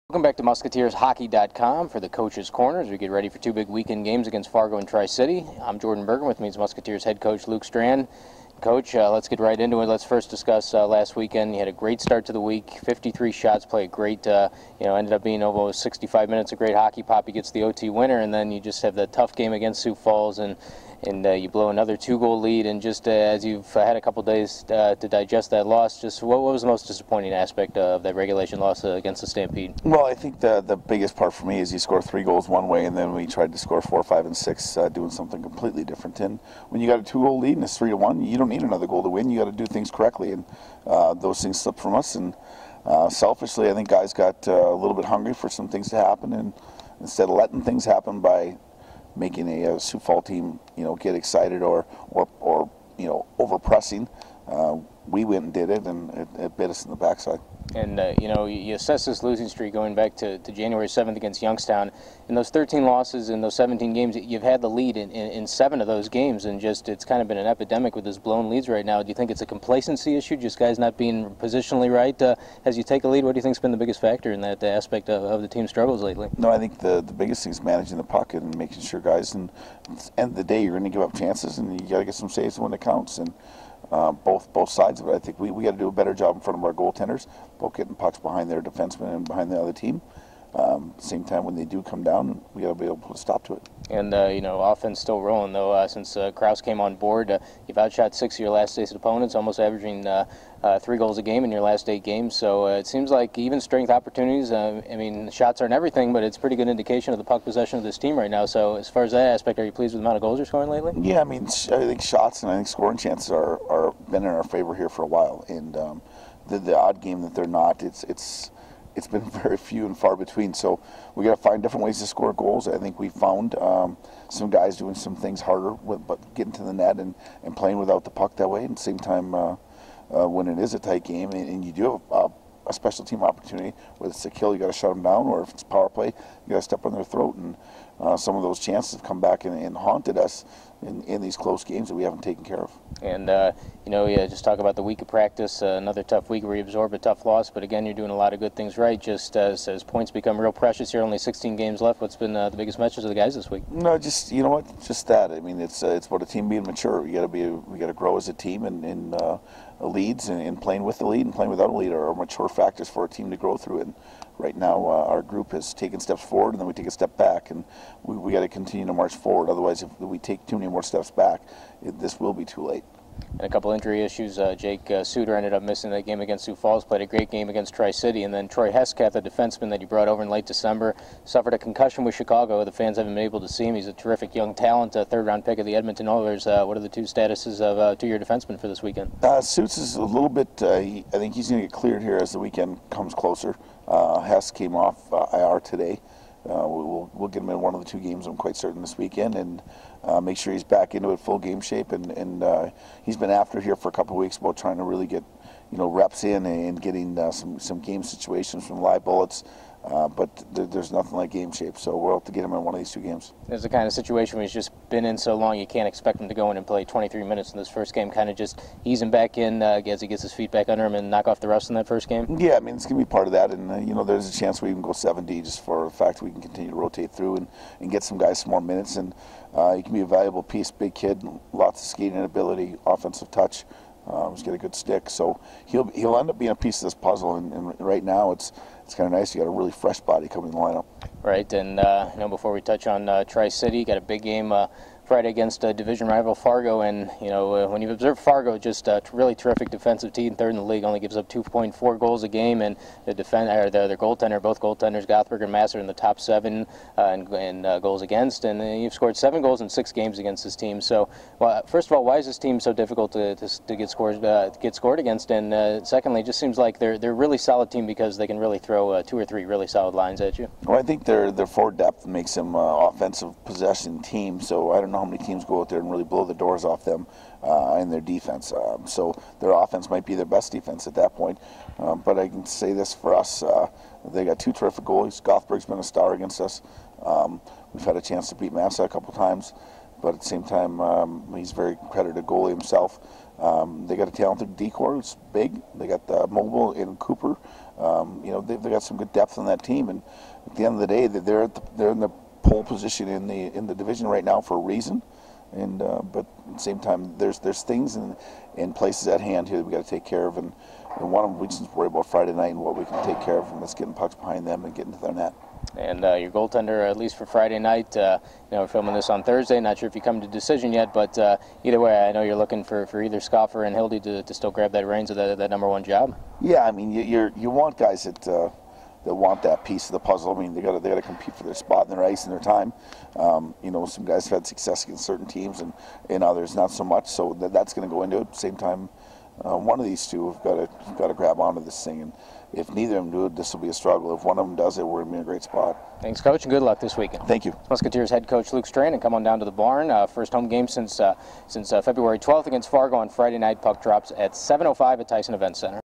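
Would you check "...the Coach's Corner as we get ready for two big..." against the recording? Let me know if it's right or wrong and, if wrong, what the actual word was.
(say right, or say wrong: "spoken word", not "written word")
right.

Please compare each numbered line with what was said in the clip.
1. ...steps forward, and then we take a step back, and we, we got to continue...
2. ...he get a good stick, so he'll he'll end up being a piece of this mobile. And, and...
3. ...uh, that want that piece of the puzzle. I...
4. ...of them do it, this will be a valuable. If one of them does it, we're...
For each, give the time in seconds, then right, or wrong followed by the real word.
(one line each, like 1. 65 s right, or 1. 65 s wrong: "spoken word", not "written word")
1. 165 s right
2. 234 s wrong: "puzzle", not "mobile"
3. 328 s right
4. 342 s wrong: "struggle", not "valuable".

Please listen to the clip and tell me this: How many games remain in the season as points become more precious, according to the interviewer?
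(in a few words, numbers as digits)
16.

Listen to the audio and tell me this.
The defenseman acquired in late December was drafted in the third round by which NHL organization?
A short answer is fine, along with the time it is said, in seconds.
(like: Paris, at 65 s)
Edmonton Oilers, at 185 s.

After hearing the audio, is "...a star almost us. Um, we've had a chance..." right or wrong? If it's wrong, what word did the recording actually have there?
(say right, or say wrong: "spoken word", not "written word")
wrong: "against", not "almost".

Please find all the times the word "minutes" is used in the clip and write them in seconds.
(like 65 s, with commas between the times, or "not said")
16 s, 217 s, 228 s.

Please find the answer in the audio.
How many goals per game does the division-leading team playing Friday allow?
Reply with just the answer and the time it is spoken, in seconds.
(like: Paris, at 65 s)
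2.4, at 251 s.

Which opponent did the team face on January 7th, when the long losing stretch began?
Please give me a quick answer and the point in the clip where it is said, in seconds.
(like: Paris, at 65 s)
Youngstown, at 61 s.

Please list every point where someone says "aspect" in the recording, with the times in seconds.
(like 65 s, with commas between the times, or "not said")
27 s, 74 s, 109 s.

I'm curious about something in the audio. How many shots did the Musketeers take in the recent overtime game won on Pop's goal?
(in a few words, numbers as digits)
53.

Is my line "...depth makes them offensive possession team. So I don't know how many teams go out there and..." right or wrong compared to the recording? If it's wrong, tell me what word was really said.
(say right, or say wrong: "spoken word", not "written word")
right.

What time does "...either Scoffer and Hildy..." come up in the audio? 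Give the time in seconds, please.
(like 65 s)
323 s.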